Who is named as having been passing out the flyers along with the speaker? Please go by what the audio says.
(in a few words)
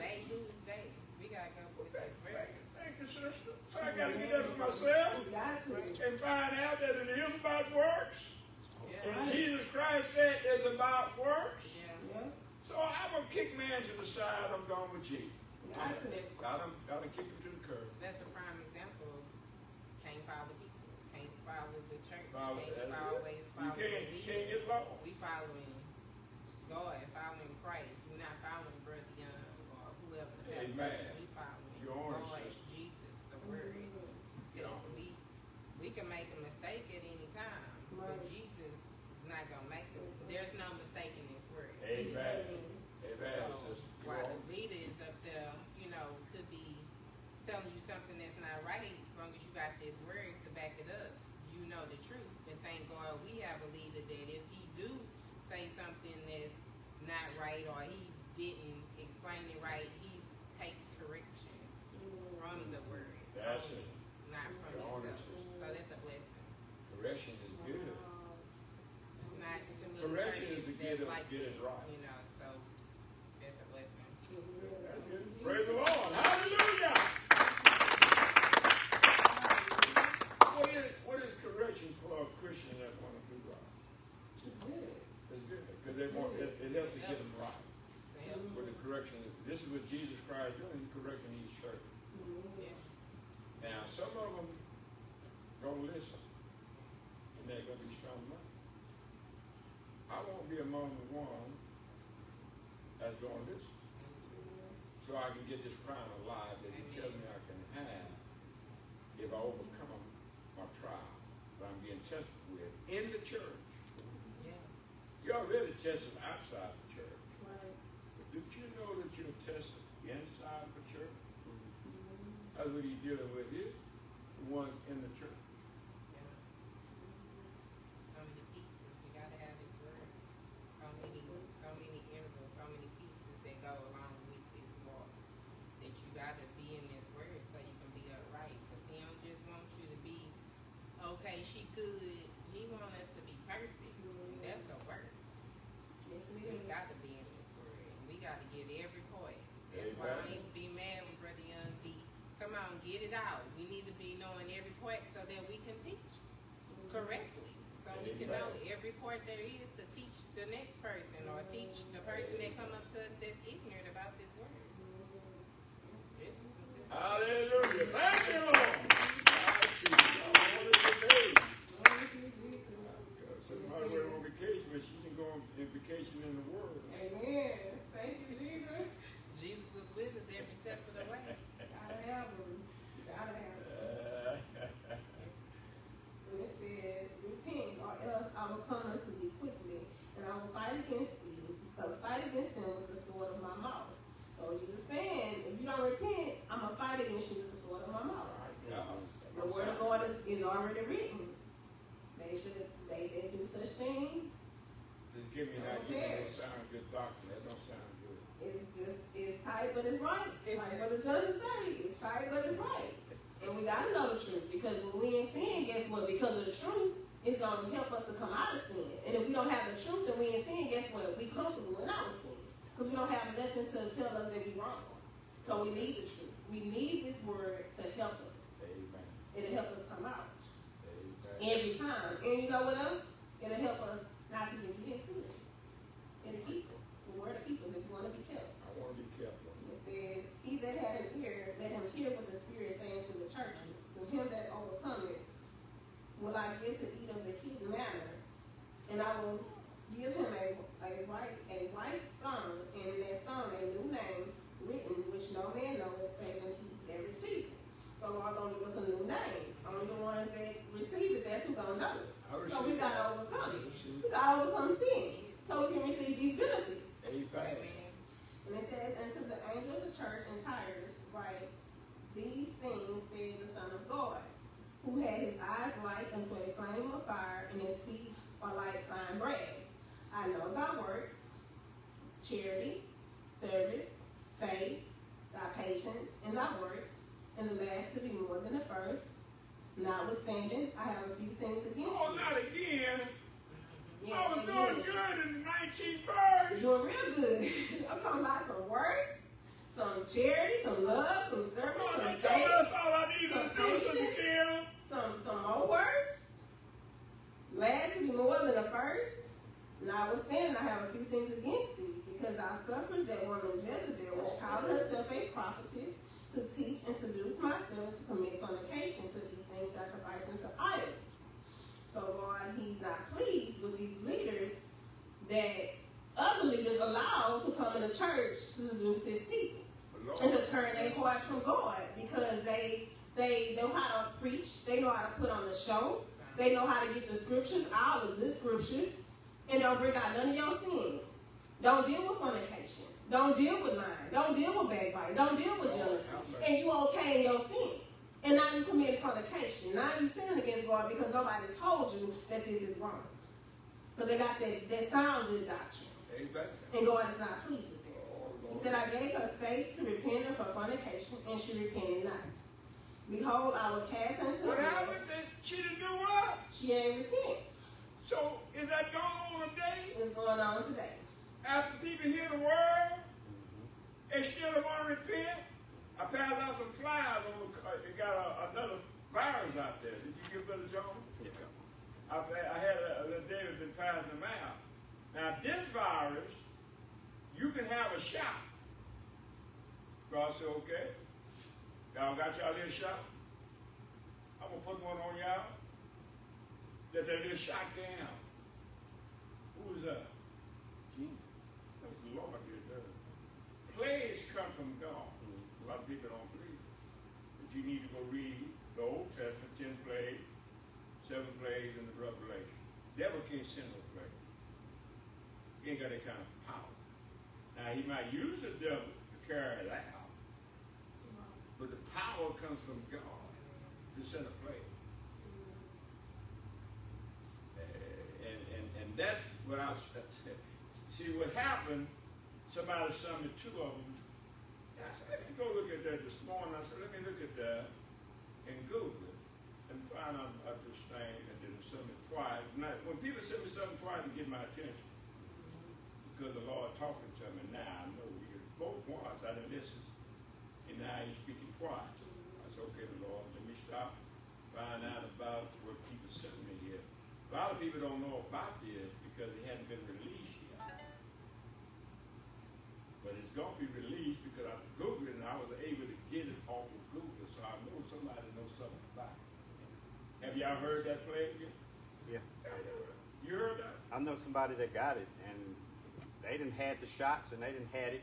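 David.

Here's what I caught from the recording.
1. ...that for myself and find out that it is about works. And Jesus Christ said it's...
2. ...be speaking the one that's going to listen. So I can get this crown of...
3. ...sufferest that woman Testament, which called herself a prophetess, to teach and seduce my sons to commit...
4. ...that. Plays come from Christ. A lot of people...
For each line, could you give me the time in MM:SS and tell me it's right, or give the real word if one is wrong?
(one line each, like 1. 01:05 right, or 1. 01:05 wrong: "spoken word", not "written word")
1. 00:04 right
2. 01:40 wrong: "among", not "speaking"
3. 05:12 wrong: "Jezebel", not "Testament"
4. 06:42 wrong: "God", not "Christ".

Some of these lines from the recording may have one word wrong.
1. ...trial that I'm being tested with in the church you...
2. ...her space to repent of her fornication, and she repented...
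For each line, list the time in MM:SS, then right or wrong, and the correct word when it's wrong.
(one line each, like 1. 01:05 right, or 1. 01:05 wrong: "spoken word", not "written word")
1. 01:50 right
2. 05:59 right.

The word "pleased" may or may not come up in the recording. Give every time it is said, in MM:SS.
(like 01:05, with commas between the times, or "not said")
05:23, 05:57.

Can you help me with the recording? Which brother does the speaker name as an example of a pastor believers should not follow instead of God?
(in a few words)
Brother Young.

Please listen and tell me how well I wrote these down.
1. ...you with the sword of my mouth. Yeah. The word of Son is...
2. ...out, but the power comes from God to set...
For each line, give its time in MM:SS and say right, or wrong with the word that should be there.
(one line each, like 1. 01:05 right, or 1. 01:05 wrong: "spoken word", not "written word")
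1. 03:17 wrong: "God", not "Son"
2. 06:59 right.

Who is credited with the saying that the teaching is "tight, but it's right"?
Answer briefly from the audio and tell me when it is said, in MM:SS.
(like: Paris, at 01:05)
Brother Justin, at 03:30.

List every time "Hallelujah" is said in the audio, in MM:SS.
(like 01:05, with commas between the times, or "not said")
01:16, 02:46.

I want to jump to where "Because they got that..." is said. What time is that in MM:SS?
05:53.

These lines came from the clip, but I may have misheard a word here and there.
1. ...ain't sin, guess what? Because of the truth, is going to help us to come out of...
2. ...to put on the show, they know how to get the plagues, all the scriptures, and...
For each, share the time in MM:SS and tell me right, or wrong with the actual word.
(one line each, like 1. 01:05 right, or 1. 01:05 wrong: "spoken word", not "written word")
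1. 03:35 right
2. 05:35 wrong: "scriptures", not "plagues".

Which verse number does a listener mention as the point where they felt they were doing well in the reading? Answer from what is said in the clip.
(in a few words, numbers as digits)
19.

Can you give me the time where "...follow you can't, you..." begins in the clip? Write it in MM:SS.
00:23.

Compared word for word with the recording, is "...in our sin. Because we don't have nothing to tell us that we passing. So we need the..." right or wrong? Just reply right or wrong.
wrong.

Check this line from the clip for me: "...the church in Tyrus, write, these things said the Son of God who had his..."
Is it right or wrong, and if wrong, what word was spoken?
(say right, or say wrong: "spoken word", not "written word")
right.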